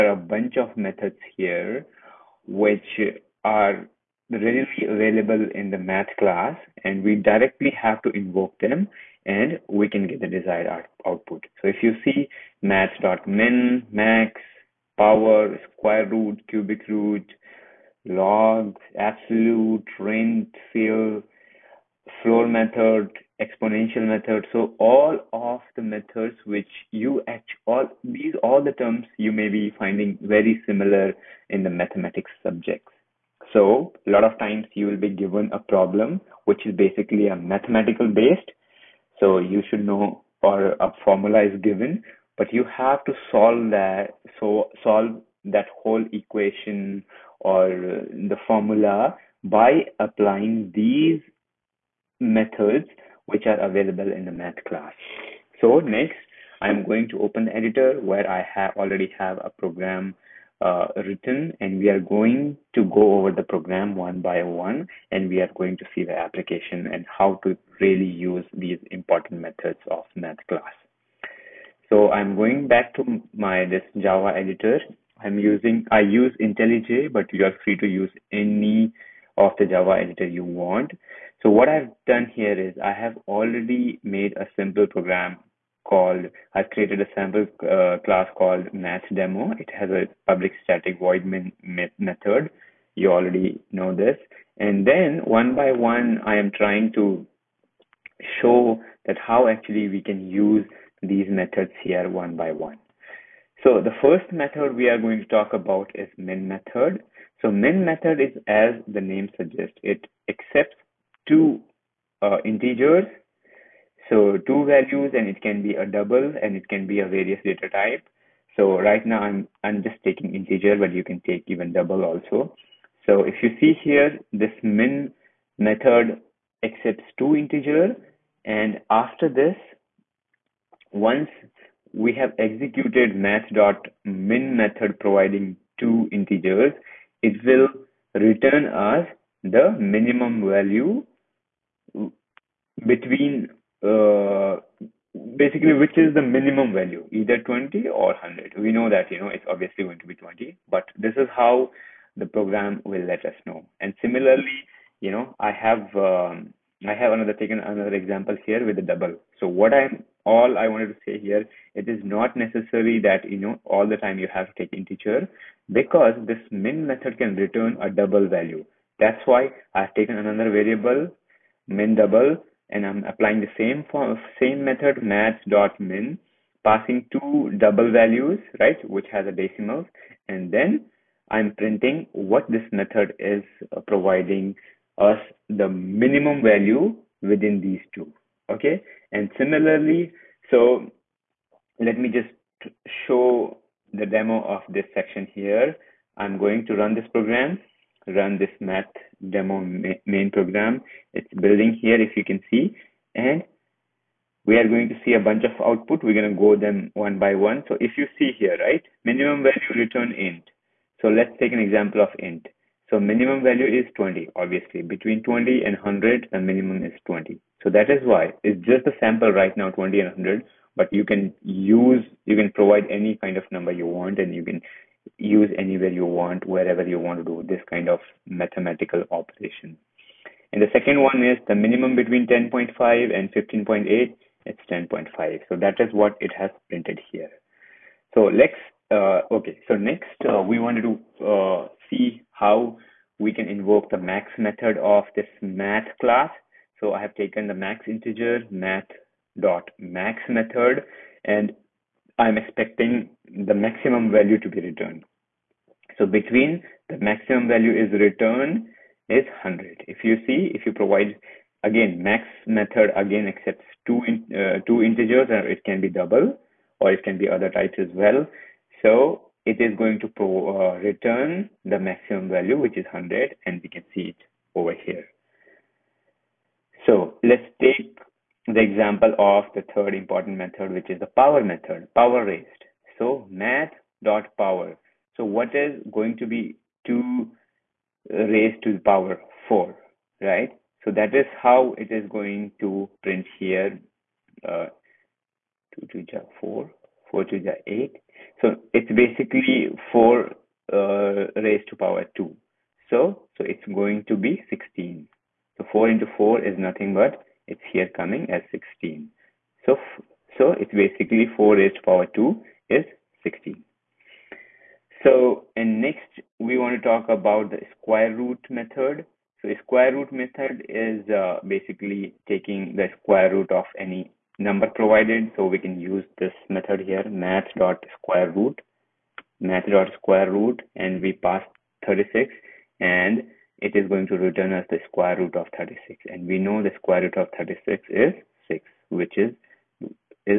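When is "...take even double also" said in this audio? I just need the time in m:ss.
2:01.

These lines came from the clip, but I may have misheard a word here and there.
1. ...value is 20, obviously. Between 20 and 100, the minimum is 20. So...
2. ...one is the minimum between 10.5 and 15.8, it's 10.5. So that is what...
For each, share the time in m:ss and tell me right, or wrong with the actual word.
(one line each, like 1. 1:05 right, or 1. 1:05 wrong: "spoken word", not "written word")
1. 3:33 right
2. 3:51 right.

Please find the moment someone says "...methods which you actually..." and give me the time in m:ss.
0:25.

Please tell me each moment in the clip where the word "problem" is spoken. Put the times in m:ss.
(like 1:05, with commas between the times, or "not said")
0:35.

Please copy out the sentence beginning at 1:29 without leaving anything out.
It has a public static void method.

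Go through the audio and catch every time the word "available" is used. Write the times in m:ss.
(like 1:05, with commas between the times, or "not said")
0:04, 0:53.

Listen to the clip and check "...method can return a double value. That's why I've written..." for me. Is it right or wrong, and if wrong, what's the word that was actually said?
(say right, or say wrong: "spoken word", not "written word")
wrong: "taken", not "written".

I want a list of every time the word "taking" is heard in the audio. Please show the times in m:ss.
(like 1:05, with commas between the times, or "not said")
2:00, 5:22.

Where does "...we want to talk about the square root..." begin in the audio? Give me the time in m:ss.
5:16.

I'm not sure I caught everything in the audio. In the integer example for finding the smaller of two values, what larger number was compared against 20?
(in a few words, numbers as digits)
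100.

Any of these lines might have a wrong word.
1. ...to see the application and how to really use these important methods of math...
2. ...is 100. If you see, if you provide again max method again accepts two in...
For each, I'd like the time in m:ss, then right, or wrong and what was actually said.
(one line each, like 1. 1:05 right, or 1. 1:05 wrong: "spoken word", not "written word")
1. 1:05 right
2. 4:19 right.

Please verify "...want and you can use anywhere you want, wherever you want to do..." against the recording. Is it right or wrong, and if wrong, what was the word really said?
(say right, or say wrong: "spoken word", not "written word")
right.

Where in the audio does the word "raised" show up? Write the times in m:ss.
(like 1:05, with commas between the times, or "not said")
4:42, 4:48, 5:01, 5:11.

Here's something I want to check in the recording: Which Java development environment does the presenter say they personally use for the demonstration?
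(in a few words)
IntelliJ.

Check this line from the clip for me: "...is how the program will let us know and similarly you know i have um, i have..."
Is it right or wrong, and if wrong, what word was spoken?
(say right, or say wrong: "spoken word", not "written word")
right.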